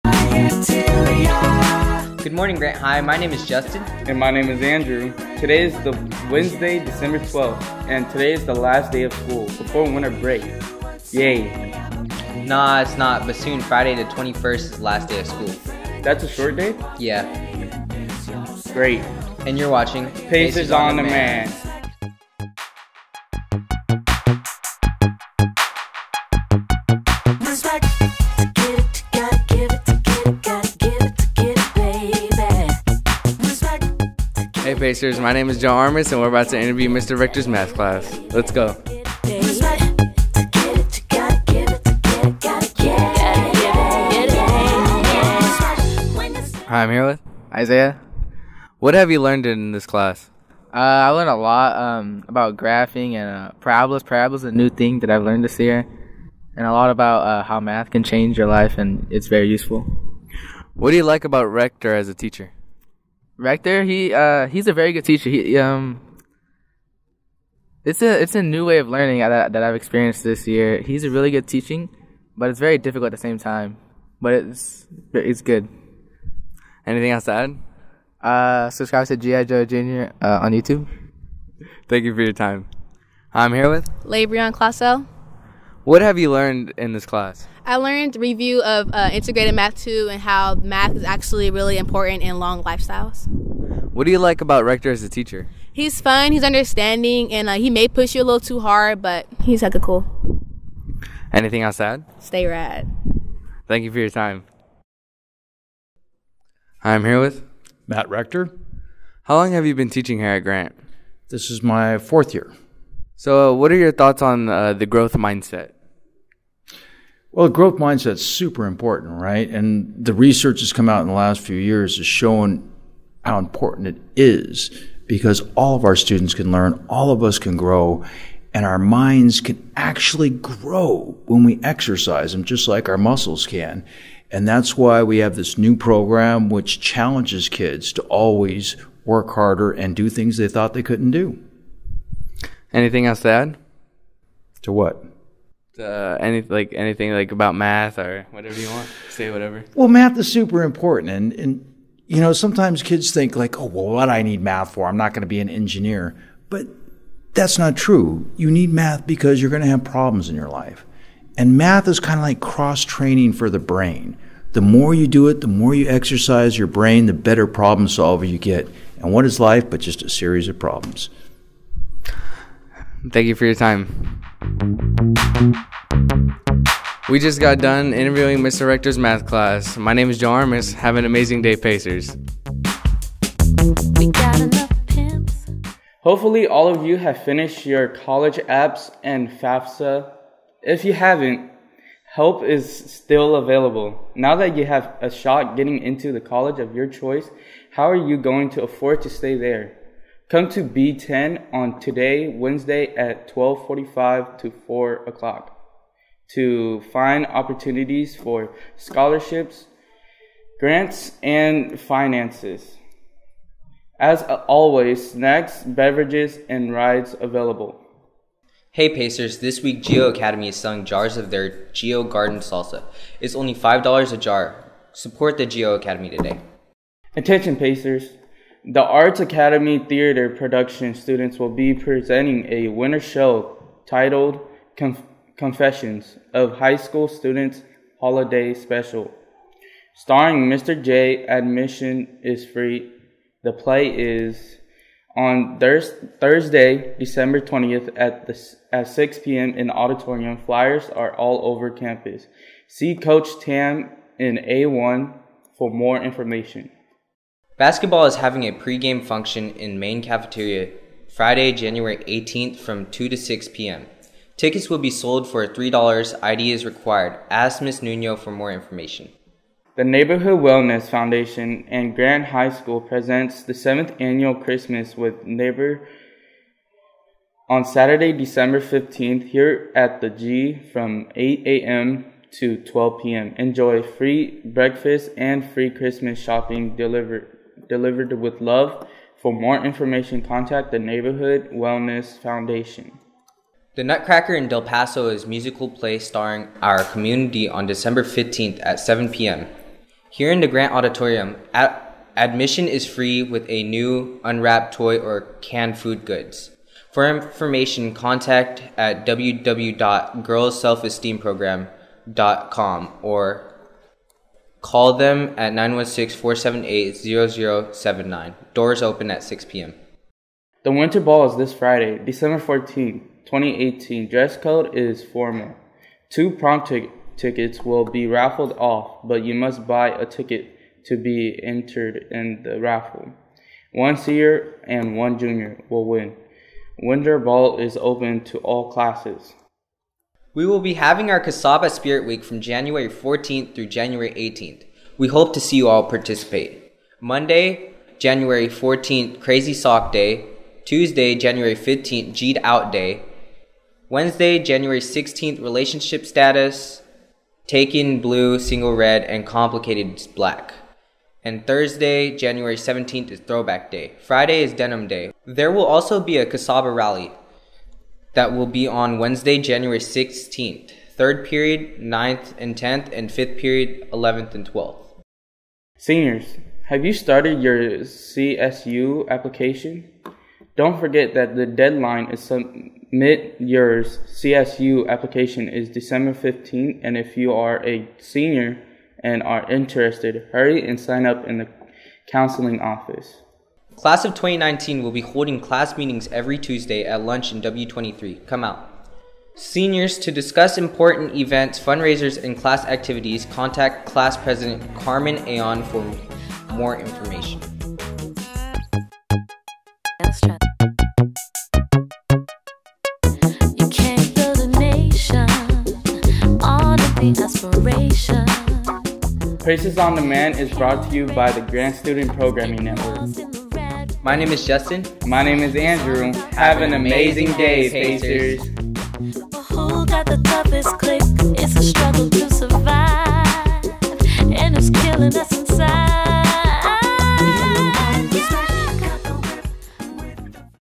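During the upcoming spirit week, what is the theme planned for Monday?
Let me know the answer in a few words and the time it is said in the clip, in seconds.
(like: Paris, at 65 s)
Crazy Sock Day, at 349 s.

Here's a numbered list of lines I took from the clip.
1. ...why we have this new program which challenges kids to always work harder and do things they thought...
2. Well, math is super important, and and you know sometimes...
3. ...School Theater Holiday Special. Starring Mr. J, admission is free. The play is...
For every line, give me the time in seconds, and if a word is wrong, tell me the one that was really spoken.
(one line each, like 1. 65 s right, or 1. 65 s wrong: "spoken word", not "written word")
1. 134 s right
2. 149 s right
3. 236 s wrong: "Students", not "Theater".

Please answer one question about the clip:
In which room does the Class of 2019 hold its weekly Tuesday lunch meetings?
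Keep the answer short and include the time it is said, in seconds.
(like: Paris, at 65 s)
W23, at 397 s.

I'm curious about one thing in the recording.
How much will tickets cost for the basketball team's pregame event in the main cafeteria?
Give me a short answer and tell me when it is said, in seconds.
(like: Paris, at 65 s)
$3, at 265 s.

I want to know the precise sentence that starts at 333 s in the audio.
One senior and one junior will win.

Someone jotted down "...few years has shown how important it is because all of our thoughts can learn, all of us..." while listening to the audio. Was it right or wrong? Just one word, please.
wrong.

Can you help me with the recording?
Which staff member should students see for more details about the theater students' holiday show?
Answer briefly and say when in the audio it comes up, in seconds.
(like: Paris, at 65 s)
Coach Tam, at 252 s.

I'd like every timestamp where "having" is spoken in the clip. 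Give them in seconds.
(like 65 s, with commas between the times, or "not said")
258 s, 340 s.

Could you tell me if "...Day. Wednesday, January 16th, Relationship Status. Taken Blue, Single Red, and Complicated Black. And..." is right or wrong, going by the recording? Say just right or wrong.
right.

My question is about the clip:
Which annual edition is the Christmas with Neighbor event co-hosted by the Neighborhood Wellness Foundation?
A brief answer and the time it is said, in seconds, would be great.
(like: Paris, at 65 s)
7th, at 273 s.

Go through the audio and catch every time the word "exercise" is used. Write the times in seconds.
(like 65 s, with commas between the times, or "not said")
131 s, 165 s.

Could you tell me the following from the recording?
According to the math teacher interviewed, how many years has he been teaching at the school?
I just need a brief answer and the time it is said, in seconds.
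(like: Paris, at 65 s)
4, at 111 s.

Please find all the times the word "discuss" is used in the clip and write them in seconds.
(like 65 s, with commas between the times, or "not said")
400 s.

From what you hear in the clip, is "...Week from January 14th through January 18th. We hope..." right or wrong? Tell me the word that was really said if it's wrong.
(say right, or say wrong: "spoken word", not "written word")
right.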